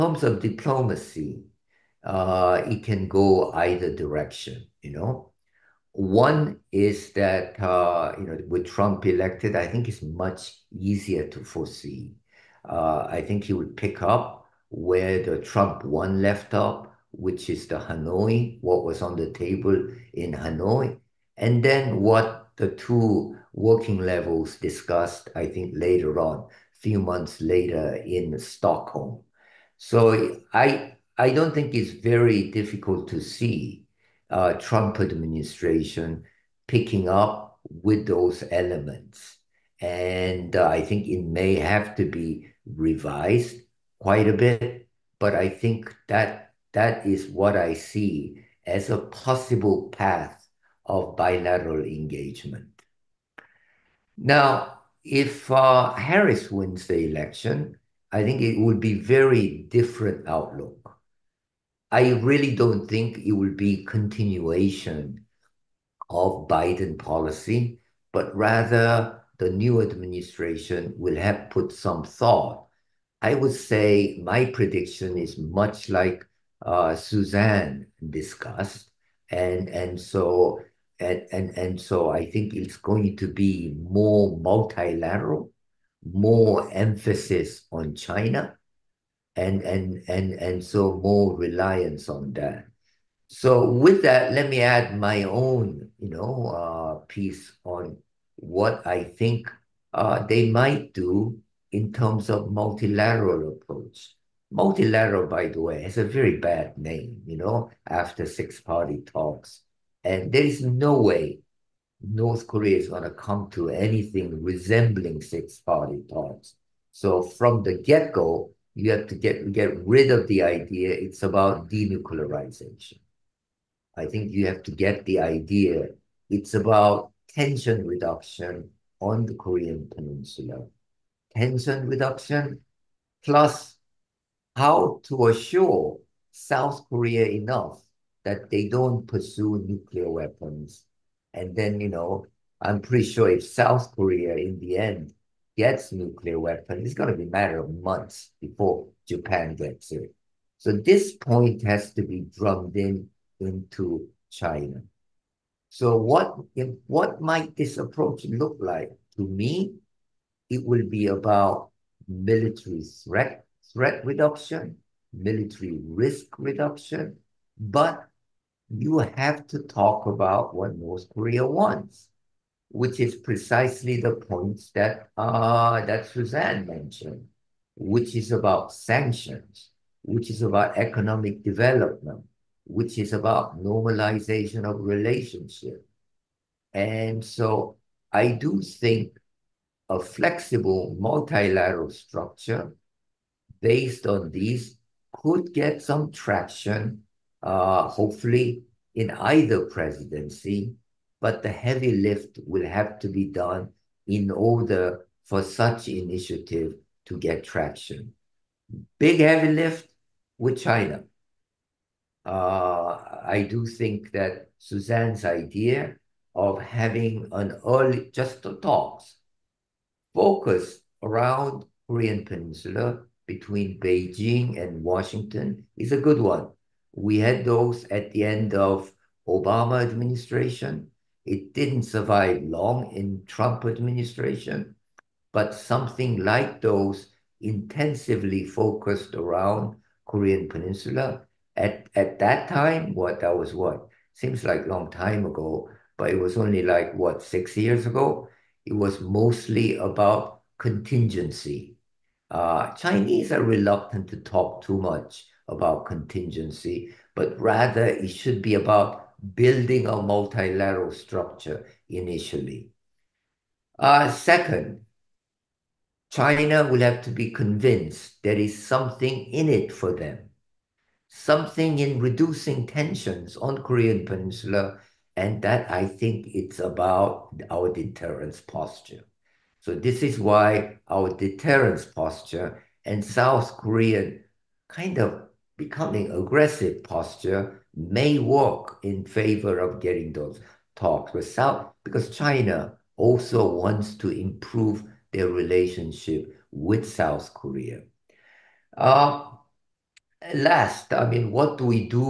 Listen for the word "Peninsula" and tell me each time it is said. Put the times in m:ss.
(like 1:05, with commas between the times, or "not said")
2:09, 3:42, 4:00, 4:34.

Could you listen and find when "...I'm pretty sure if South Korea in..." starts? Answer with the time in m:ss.
2:22.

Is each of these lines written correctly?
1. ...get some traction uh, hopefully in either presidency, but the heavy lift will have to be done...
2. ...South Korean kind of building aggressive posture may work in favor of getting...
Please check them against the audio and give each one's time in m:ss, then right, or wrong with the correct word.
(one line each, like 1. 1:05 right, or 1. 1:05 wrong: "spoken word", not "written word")
1. 3:15 right
2. 4:43 wrong: "becoming", not "building".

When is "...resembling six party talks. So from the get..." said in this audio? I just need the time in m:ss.
1:54.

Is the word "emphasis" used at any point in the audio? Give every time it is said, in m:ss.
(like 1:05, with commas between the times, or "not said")
1:26.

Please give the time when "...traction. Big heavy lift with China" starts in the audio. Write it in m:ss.
3:27.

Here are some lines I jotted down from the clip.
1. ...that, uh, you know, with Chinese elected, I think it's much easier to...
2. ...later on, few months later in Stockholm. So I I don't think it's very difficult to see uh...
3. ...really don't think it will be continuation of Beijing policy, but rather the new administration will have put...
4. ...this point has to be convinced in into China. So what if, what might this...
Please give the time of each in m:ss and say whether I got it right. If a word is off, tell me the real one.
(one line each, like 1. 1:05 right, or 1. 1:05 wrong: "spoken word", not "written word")
1. 0:07 wrong: "Trump", not "Chinese"
2. 0:25 right
3. 1:02 wrong: "Biden", not "Beijing"
4. 2:30 wrong: "drummed", not "convinced".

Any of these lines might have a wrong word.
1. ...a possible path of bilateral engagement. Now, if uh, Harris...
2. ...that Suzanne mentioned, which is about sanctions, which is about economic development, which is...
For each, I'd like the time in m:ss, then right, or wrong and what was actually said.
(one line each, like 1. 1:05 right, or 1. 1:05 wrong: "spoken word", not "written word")
1. 0:48 right
2. 2:55 right.